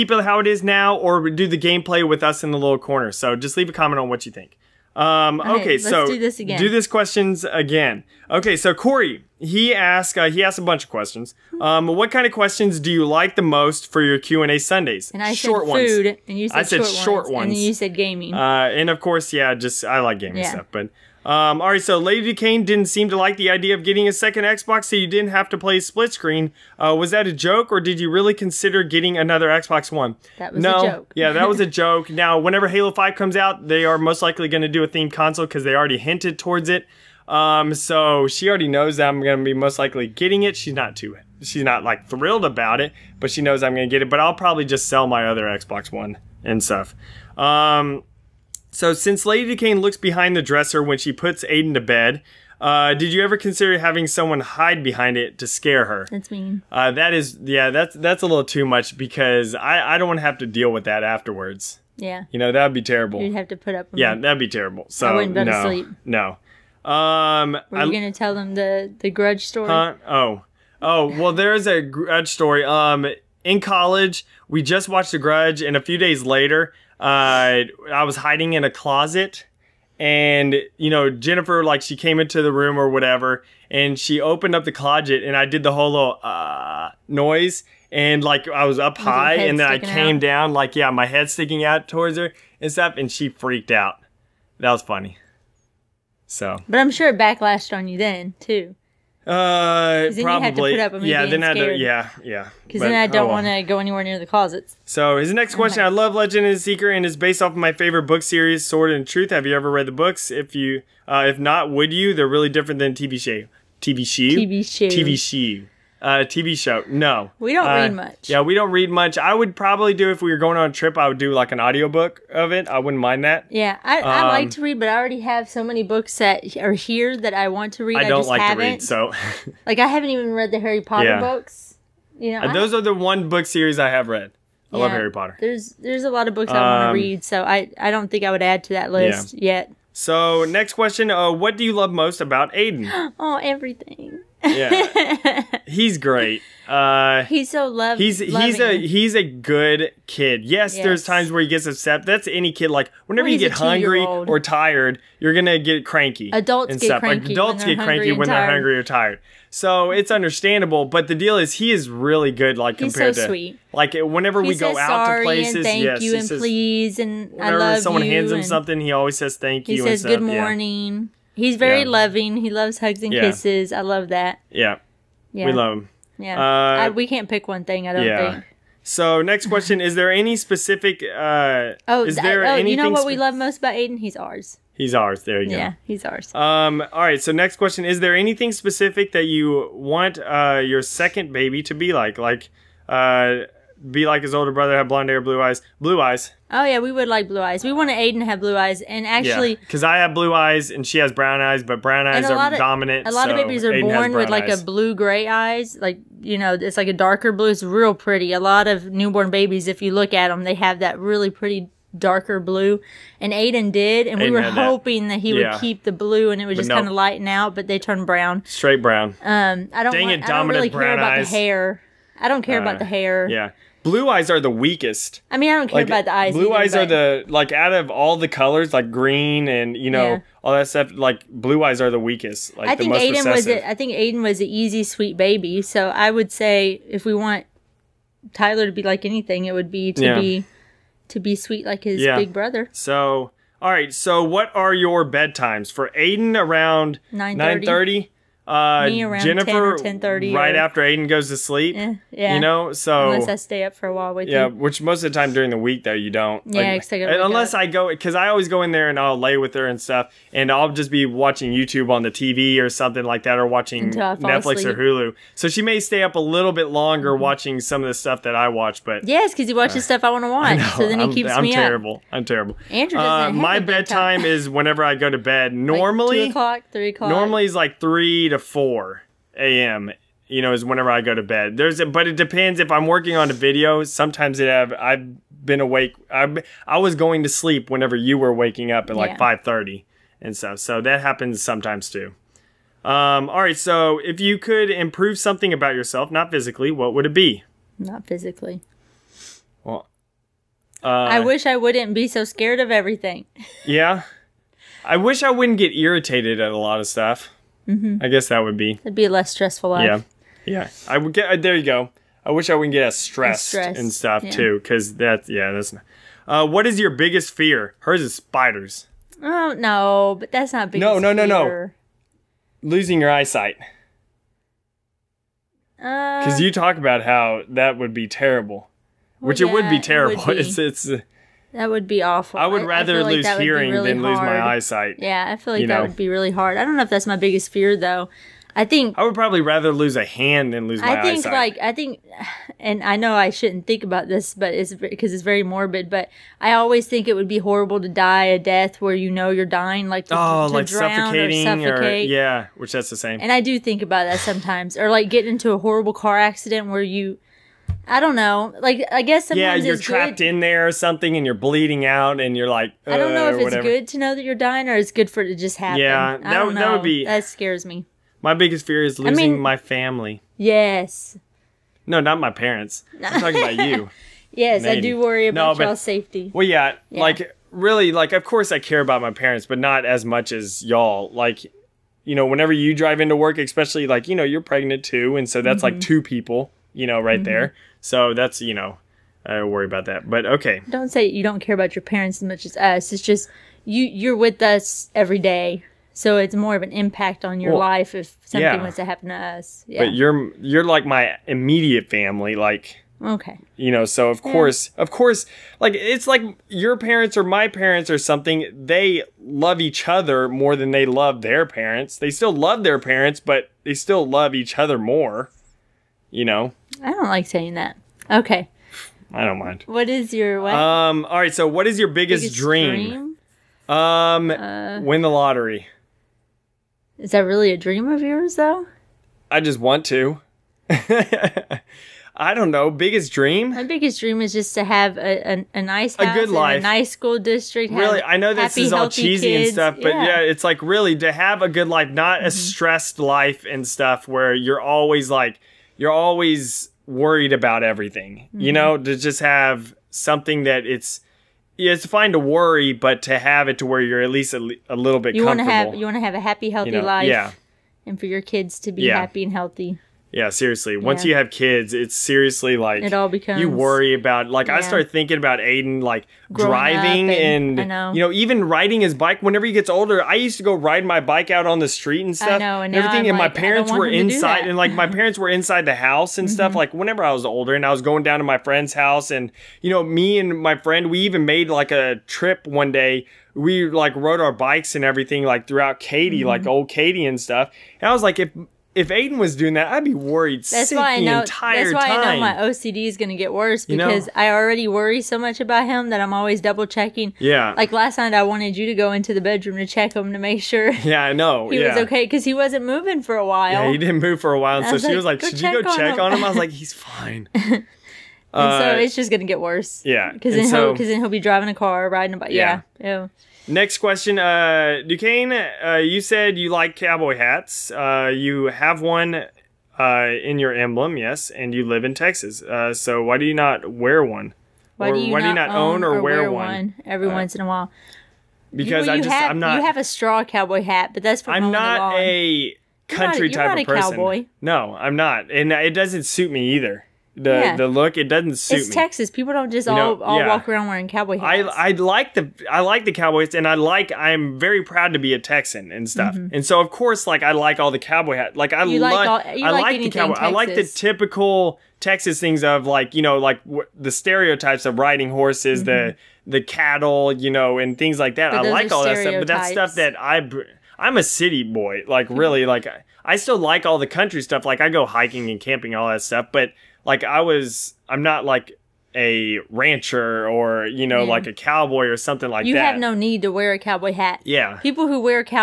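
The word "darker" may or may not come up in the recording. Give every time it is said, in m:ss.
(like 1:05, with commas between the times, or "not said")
3:26, 3:31.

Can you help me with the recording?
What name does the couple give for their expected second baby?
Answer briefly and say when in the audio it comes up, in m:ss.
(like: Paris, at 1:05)
Tyler, at 3:58.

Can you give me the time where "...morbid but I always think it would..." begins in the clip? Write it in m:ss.
5:45.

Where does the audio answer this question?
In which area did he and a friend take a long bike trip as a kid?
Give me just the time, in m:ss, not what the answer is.
8:06.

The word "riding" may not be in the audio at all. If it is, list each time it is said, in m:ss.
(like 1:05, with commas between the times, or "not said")
7:48, 8:31, 9:14.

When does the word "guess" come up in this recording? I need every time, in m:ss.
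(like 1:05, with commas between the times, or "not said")
5:08, 5:59.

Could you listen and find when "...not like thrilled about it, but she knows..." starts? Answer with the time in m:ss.
0:41.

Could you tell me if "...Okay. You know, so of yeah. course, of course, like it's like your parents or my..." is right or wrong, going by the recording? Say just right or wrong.
right.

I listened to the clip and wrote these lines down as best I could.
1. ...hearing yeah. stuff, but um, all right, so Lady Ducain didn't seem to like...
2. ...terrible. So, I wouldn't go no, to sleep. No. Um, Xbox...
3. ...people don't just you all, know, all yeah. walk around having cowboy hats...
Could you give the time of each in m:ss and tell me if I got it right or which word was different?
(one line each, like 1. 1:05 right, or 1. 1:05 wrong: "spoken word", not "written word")
1. 0:20 wrong: "gaming", not "hearing"
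2. 1:04 wrong: "Were", not "Xbox"
3. 8:59 wrong: "wearing", not "having".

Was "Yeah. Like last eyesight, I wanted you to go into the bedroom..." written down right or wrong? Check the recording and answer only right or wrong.
wrong.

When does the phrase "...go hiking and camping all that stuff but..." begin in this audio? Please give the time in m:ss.
9:24.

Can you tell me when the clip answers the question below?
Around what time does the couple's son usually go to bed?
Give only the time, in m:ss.
4:07.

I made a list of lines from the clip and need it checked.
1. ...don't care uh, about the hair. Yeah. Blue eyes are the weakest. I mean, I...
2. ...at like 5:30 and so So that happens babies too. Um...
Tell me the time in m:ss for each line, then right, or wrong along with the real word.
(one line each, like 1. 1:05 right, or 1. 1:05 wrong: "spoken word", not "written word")
1. 3:42 right
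2. 4:48 wrong: "sometimes", not "babies".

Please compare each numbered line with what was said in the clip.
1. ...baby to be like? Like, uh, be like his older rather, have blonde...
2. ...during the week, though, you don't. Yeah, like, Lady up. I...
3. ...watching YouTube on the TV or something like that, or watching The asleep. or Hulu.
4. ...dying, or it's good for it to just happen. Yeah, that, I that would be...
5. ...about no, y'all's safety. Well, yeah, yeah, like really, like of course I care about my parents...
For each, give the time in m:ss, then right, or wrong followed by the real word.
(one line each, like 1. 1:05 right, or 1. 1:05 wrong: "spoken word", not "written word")
1. 3:11 wrong: "brother", not "rather"
2. 4:15 wrong: "Unless", not "Lady"
3. 4:21 wrong: "Netflix", not "The"
4. 6:04 right
5. 6:15 right.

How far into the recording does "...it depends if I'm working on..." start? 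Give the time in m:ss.
4:42.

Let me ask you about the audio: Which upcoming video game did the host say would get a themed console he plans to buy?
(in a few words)
Halo 5.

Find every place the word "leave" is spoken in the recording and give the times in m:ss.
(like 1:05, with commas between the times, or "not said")
0:03.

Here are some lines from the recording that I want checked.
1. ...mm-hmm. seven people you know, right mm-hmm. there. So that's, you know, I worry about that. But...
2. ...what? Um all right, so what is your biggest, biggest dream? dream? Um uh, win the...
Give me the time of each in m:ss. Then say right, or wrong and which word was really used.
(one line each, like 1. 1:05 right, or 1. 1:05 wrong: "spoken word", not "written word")
1. 6:25 wrong: "two", not "seven"
2. 7:00 right.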